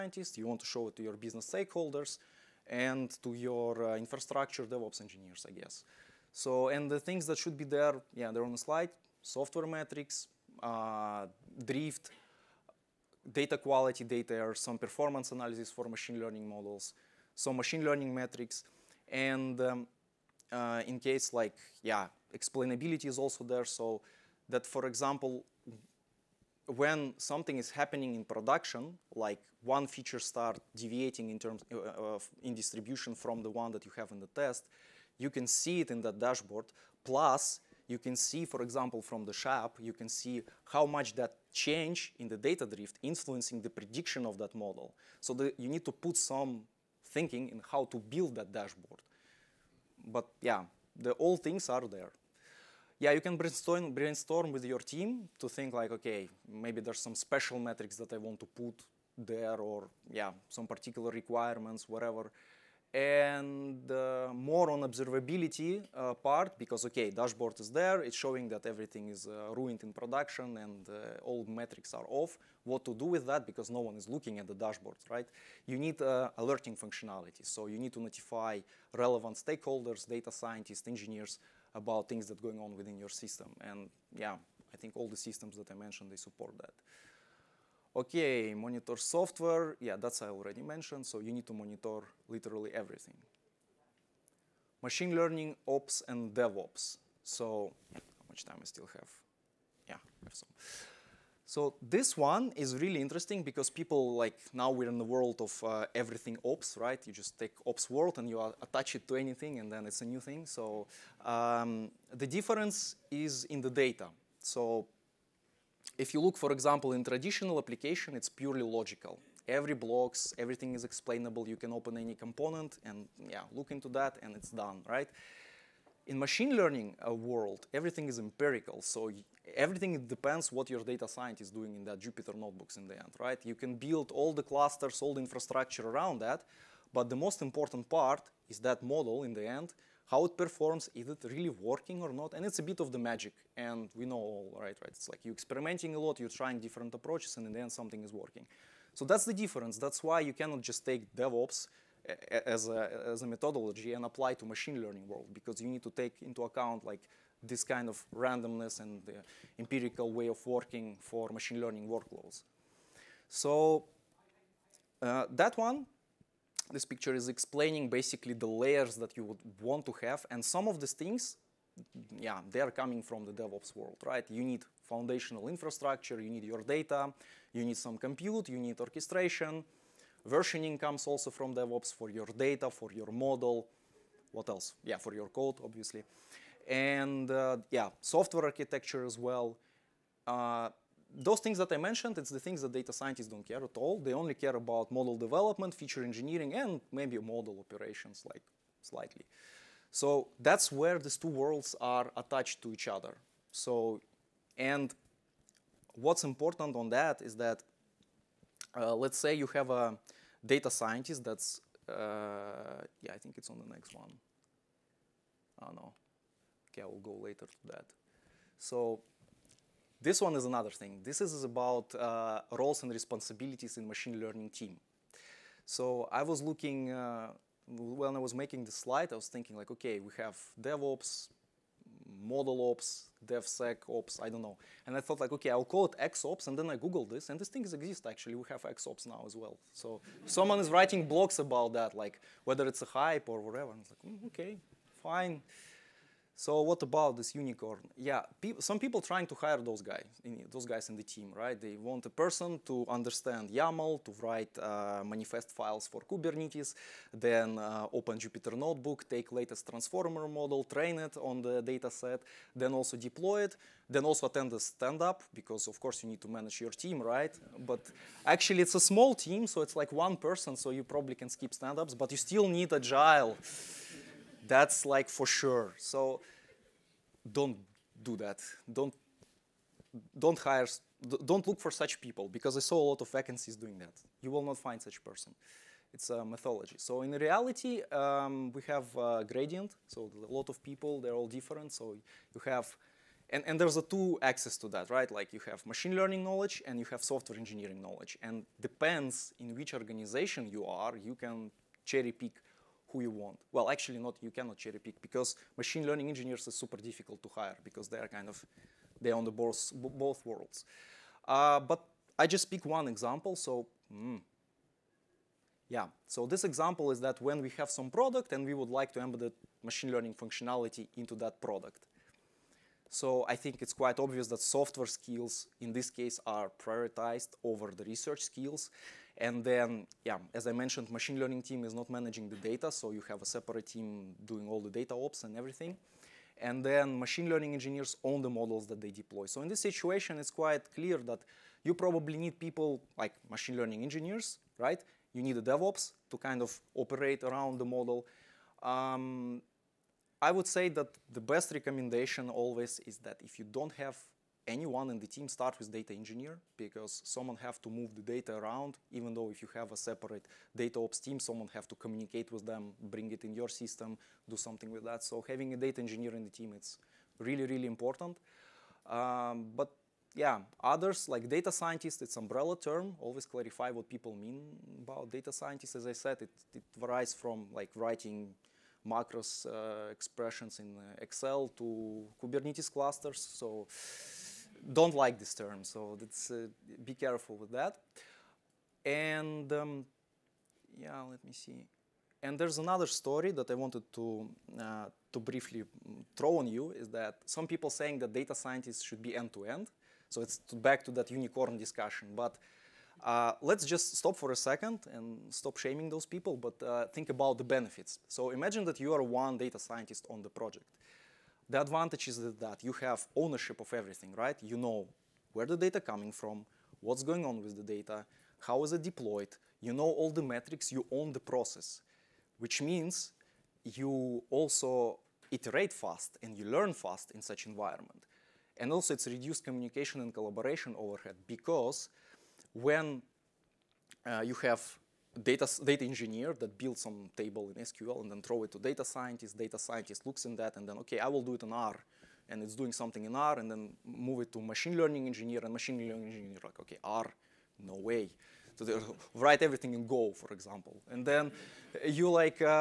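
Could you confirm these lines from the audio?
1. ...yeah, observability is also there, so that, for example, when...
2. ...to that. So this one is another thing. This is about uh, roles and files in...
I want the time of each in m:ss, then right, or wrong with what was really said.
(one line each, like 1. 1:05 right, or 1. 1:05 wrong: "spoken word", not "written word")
1. 0:21 wrong: "explainability", not "observability"
2. 3:37 wrong: "responsibilities", not "files".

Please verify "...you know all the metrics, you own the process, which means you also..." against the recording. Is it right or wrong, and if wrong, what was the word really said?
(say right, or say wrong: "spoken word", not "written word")
right.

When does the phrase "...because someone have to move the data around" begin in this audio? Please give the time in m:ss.
5:56.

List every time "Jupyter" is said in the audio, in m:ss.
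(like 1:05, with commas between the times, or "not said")
2:11, 4:18.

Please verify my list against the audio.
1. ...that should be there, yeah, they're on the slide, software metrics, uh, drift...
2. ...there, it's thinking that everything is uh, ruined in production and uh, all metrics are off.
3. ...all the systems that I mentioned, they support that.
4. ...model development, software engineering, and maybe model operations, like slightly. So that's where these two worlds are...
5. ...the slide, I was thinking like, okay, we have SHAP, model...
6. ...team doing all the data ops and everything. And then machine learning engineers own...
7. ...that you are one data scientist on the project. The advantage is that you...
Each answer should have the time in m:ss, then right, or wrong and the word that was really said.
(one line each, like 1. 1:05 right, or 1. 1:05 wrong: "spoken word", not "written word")
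1. 0:07 right
2. 1:07 wrong: "showing", not "thinking"
3. 1:24 right
4. 3:14 wrong: "feature", not "software"
5. 3:48 wrong: "DevOps", not "SHAP"
6. 5:33 right
7. 6:48 right.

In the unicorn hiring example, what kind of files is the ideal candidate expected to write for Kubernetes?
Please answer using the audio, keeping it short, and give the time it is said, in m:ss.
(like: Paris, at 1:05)
manifest files, at 4:15.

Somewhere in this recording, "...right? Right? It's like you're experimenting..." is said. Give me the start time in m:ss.
2:24.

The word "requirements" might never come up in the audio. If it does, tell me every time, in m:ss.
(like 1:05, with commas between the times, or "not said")
1:01.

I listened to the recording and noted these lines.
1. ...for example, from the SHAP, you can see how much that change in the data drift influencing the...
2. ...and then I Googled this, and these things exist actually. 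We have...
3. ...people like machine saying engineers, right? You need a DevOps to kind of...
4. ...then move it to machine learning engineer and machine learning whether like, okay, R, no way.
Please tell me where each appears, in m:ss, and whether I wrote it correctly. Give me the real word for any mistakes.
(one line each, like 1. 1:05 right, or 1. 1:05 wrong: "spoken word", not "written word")
1. 0:38 right
2. 3:56 right
3. 5:42 wrong: "learning", not "saying"
4. 7:23 wrong: "engineer", not "whether".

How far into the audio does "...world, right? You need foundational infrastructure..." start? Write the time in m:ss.
2:53.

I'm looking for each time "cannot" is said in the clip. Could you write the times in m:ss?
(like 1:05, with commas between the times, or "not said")
2:30, 5:04.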